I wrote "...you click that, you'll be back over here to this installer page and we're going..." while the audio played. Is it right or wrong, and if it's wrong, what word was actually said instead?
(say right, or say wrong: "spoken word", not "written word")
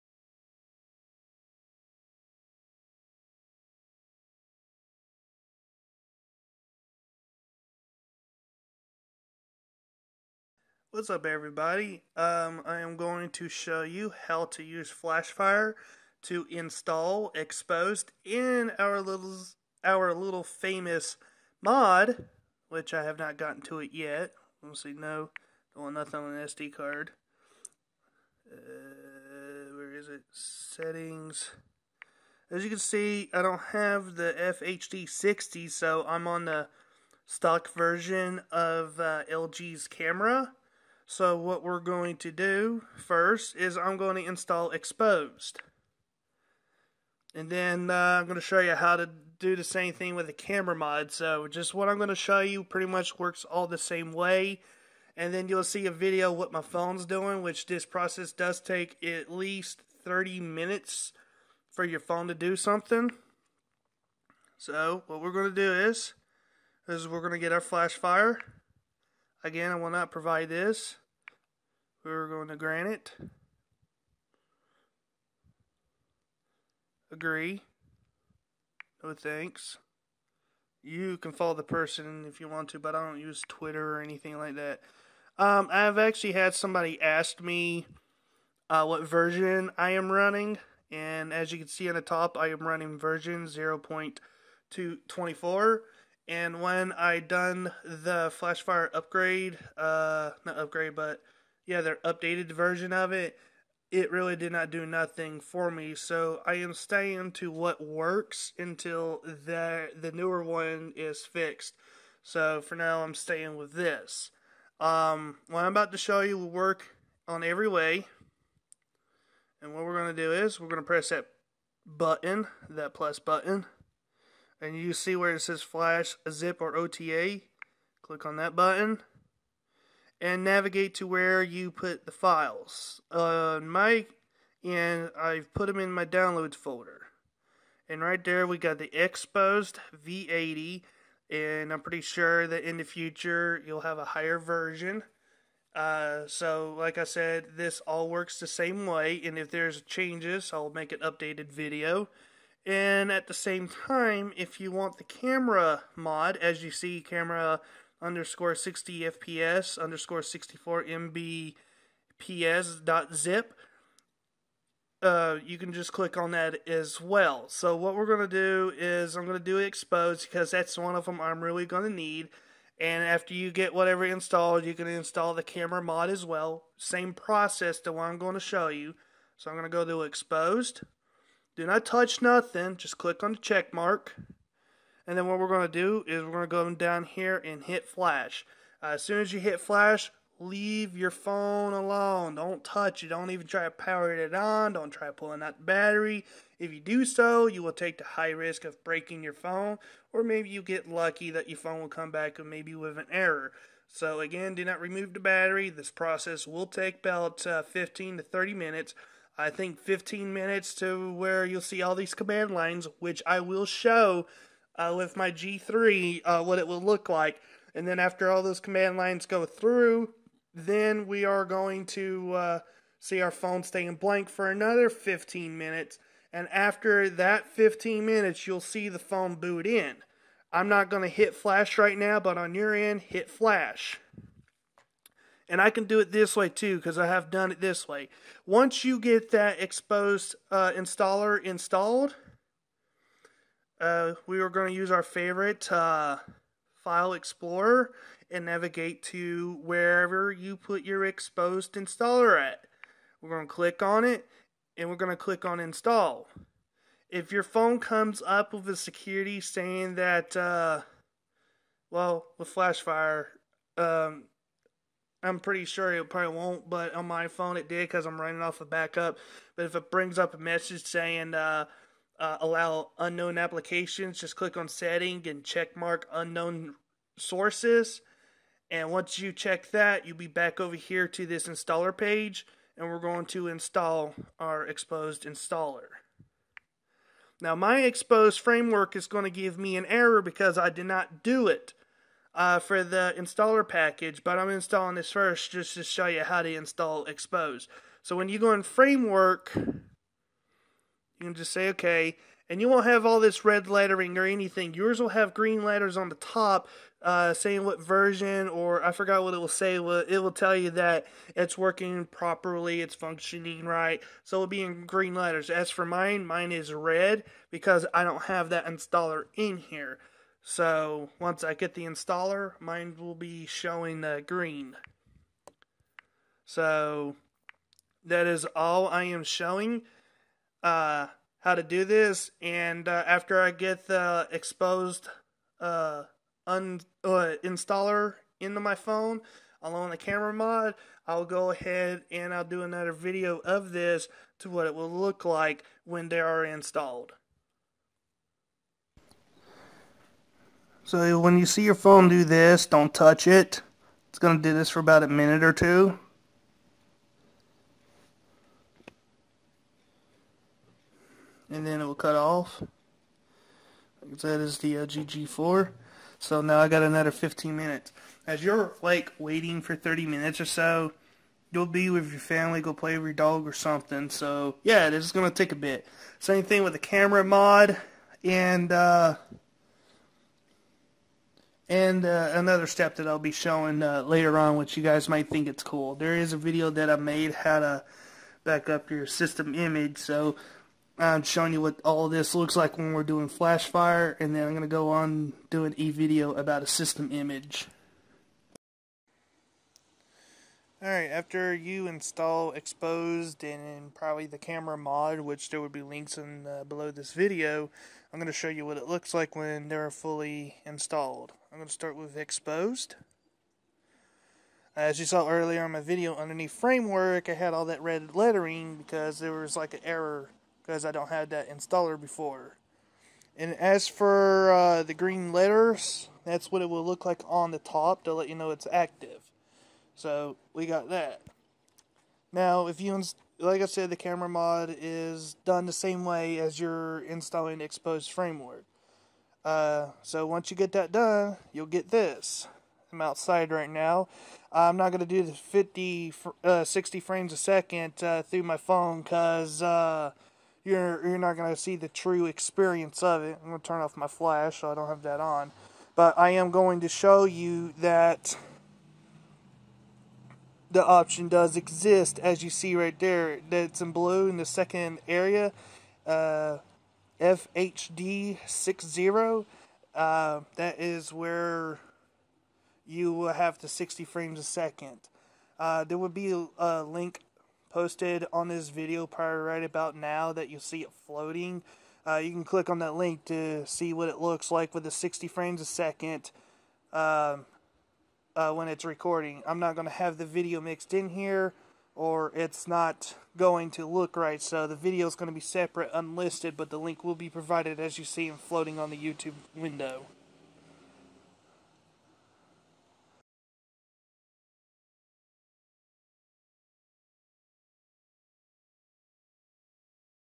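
wrong: "check", not "click".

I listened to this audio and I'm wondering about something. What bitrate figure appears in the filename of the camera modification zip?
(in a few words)
64 mbps.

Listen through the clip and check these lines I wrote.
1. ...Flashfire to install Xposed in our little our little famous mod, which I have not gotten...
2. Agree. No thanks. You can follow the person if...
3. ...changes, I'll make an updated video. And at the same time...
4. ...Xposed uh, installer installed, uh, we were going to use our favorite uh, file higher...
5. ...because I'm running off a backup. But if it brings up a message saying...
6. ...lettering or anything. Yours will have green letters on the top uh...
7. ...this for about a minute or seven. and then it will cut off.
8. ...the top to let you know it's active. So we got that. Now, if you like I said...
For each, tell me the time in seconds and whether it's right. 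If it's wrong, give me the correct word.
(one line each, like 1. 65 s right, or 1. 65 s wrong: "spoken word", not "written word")
1. 14 s right
2. 77 s right
3. 149 s right
4. 239 s wrong: "explorer", not "higher"
5. 267 s right
6. 303 s right
7. 354 s wrong: "two", not "seven"
8. 427 s right.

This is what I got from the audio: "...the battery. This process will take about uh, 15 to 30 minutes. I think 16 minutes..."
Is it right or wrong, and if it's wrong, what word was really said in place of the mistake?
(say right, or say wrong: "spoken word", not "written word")
wrong: "15", not "16".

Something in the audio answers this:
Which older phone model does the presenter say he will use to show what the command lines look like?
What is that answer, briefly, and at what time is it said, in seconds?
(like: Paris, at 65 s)
G3, at 215 s.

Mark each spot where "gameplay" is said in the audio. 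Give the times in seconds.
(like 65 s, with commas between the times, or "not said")
not said.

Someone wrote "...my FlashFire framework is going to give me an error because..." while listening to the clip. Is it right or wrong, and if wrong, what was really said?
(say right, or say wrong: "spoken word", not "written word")
wrong: "Xposed", not "FlashFire".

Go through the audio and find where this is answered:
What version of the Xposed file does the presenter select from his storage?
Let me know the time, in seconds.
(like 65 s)
140 s.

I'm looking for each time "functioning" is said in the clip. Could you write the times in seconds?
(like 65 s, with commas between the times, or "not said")
312 s.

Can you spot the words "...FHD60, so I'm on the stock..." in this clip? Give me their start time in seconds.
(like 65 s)
34 s.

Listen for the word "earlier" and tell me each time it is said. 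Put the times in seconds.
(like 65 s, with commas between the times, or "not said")
415 s.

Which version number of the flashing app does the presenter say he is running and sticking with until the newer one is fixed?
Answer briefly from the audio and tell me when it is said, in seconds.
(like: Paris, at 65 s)
0.224, at 93 s.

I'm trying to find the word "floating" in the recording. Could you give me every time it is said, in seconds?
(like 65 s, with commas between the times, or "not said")
481 s, 498 s.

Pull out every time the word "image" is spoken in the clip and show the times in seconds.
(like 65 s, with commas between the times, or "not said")
389 s, 397 s.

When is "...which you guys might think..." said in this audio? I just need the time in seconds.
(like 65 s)
384 s.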